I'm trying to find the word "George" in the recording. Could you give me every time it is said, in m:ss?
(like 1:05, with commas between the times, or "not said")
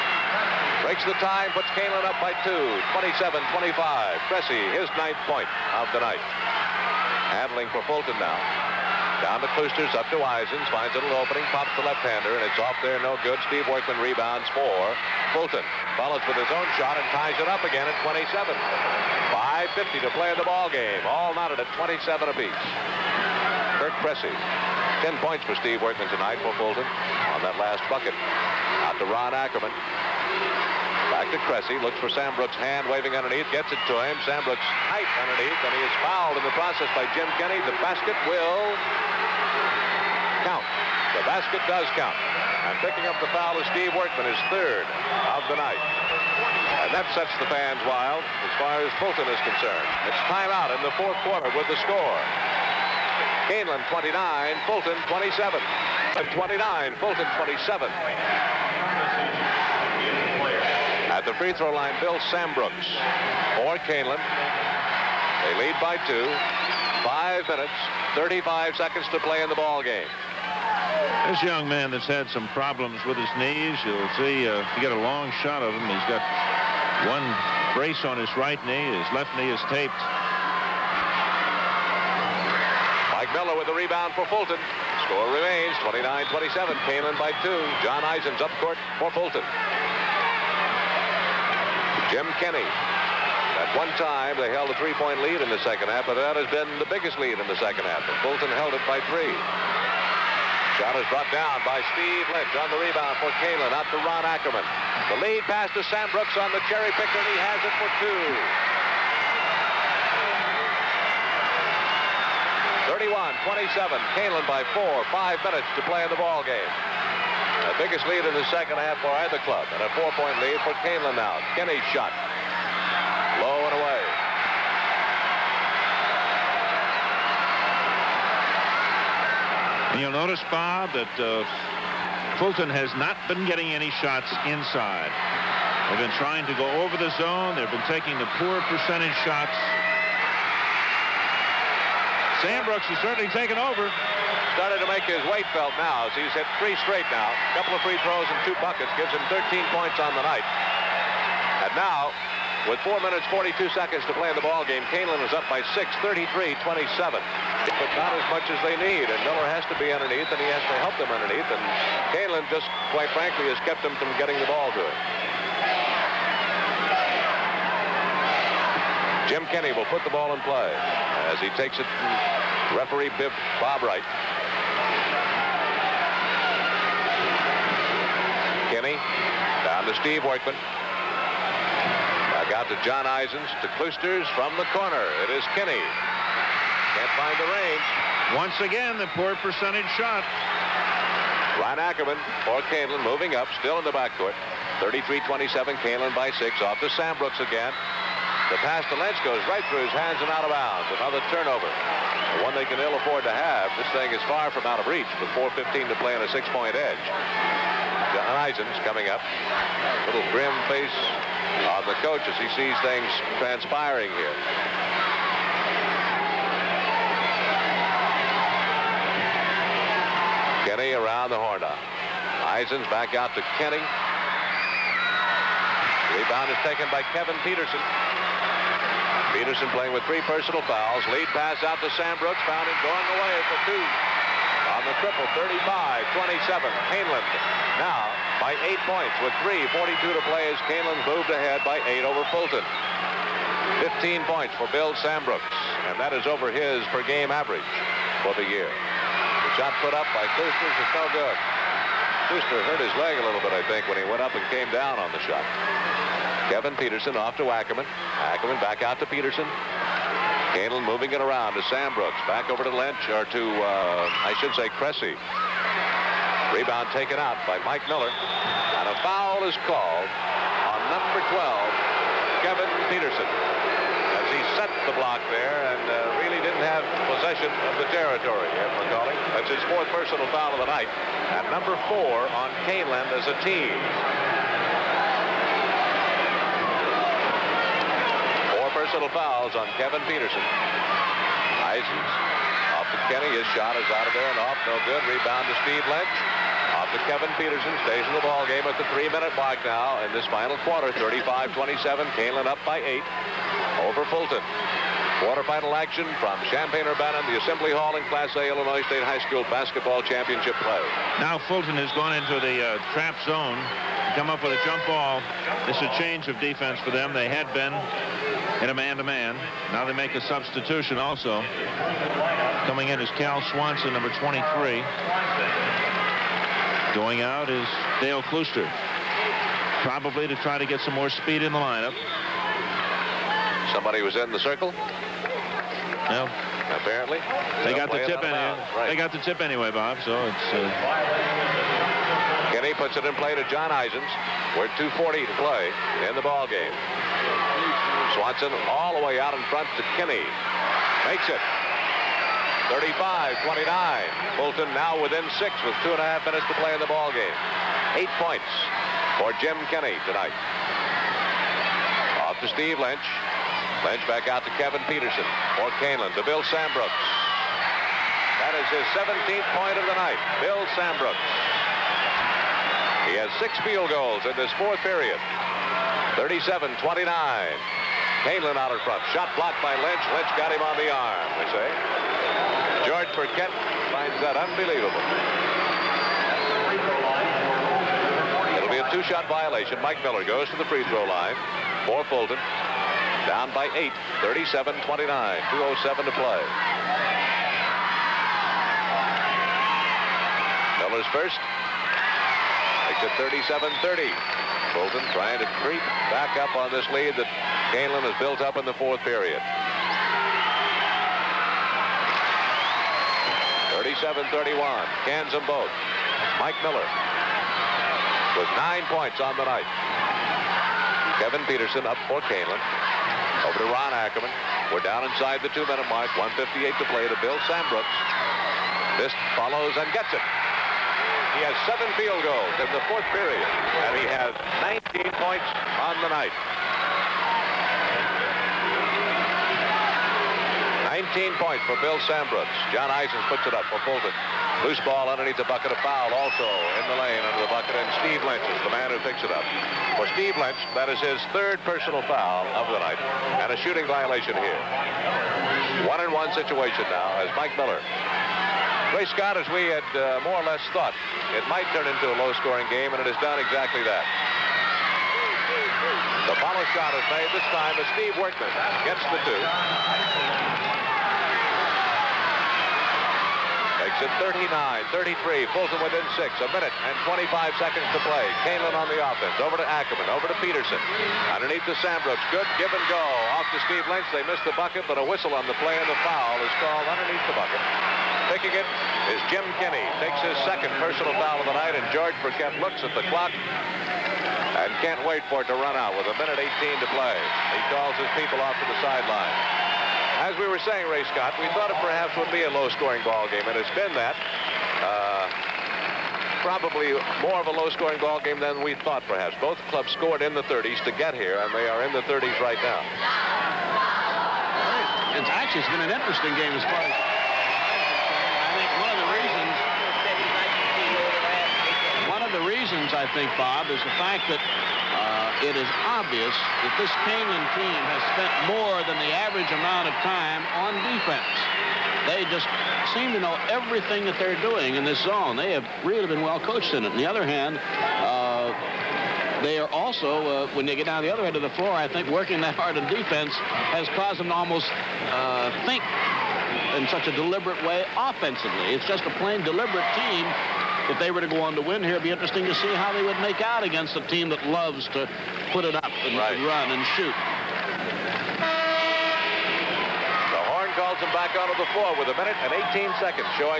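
6:22, 8:11.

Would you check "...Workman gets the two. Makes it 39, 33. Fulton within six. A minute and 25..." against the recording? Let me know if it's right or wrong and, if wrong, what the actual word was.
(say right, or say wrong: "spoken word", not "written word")
right.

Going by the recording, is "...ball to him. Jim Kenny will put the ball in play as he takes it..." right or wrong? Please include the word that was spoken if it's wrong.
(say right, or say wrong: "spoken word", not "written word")
right.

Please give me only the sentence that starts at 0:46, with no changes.
And that sets the fans wild as far as Fulton is concerned.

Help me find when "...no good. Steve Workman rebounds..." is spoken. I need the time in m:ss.
0:13.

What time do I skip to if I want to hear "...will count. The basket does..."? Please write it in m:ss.
0:38.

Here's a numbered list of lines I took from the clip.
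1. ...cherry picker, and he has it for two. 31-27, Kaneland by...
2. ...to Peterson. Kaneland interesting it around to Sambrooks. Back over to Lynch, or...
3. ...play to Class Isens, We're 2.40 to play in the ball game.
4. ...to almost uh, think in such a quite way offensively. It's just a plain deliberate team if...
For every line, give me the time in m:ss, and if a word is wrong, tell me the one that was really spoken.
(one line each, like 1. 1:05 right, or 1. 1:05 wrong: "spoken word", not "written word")
1. 1:46 right
2. 4:19 wrong: "moving", not "interesting"
3. 5:43 wrong: "John", not "Class"
4. 9:04 wrong: "deliberate", not "quite".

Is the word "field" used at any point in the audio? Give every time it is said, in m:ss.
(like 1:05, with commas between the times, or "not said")
6:13, 7:11.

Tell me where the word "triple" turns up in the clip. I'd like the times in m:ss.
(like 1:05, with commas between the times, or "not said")
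3:55.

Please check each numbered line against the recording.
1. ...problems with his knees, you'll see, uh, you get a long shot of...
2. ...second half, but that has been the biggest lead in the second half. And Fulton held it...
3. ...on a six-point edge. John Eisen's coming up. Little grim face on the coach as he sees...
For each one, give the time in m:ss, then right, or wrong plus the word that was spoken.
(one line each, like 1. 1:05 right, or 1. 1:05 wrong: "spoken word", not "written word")
1. 1:12 right
2. 1:35 right
3. 3:26 right.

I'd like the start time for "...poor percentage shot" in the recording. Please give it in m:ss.
3:09.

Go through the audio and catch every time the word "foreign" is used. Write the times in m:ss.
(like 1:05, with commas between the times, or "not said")
not said.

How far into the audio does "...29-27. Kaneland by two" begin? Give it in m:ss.
1:25.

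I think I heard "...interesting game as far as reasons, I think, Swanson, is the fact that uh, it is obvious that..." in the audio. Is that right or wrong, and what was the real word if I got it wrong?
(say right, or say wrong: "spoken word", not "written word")
wrong: "Bob", not "Swanson".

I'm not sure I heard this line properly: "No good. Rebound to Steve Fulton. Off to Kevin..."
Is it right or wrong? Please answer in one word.
wrong.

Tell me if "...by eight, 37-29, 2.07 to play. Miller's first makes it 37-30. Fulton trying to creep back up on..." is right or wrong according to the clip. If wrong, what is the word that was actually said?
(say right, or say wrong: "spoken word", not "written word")
right.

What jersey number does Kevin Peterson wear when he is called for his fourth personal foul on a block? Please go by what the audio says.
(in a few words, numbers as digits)
12.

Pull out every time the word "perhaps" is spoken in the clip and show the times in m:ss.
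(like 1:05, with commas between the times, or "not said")
8:21, 8:29.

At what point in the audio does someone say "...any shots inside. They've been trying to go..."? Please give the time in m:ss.
2:13.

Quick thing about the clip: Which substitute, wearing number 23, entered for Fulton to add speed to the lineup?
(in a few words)
Cal Swanson.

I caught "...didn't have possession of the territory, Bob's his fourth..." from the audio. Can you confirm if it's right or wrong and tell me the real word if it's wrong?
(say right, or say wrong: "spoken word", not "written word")
wrong: "That", not "Bob".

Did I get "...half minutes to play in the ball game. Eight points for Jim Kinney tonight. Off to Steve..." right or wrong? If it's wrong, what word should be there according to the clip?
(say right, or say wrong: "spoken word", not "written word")
right.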